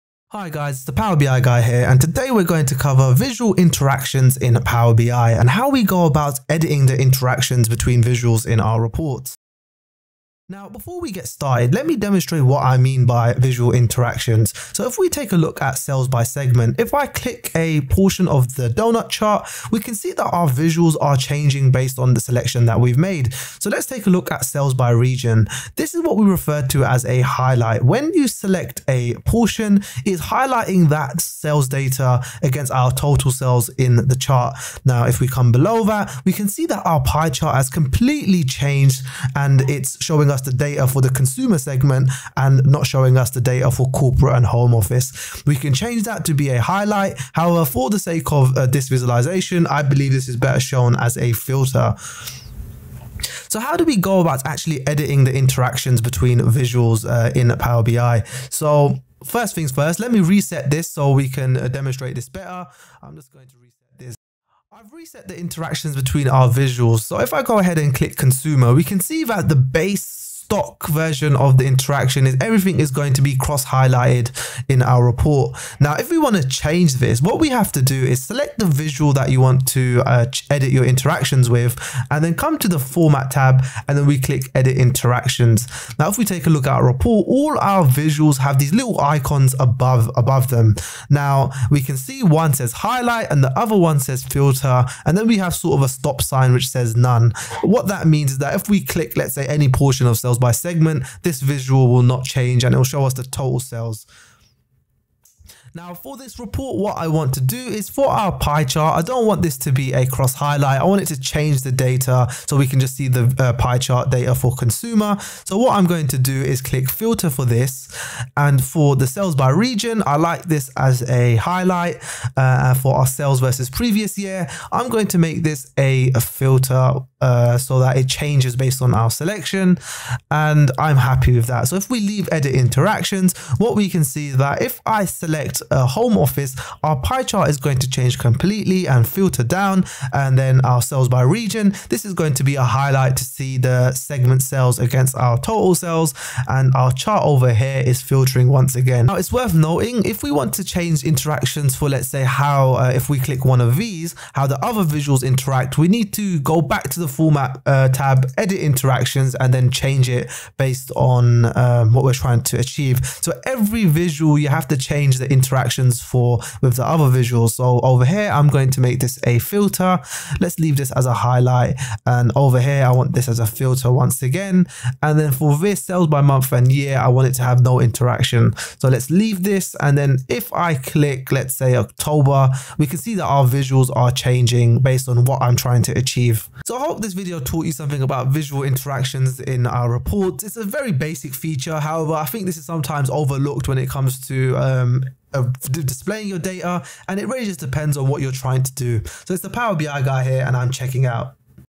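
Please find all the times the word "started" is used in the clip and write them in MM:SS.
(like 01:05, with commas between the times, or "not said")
00:11.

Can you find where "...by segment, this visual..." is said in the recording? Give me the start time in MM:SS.
01:40.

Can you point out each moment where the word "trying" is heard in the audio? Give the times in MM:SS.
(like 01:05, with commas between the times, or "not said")
02:42, 03:05, 03:18.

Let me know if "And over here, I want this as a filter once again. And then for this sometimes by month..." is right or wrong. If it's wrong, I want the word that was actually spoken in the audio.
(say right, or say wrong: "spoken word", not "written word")
wrong: "sales", not "sometimes".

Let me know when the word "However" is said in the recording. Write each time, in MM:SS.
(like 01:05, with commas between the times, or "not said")
00:47, 03:11.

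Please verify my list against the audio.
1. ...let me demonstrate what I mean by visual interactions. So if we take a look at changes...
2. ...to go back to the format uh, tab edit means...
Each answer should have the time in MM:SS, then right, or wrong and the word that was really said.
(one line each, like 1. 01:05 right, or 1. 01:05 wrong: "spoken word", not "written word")
1. 00:11 wrong: "sales", not "changes"
2. 02:36 wrong: "interactions", not "means".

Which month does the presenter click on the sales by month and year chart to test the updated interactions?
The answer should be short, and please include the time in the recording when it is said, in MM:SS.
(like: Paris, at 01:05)
October, at 03:01.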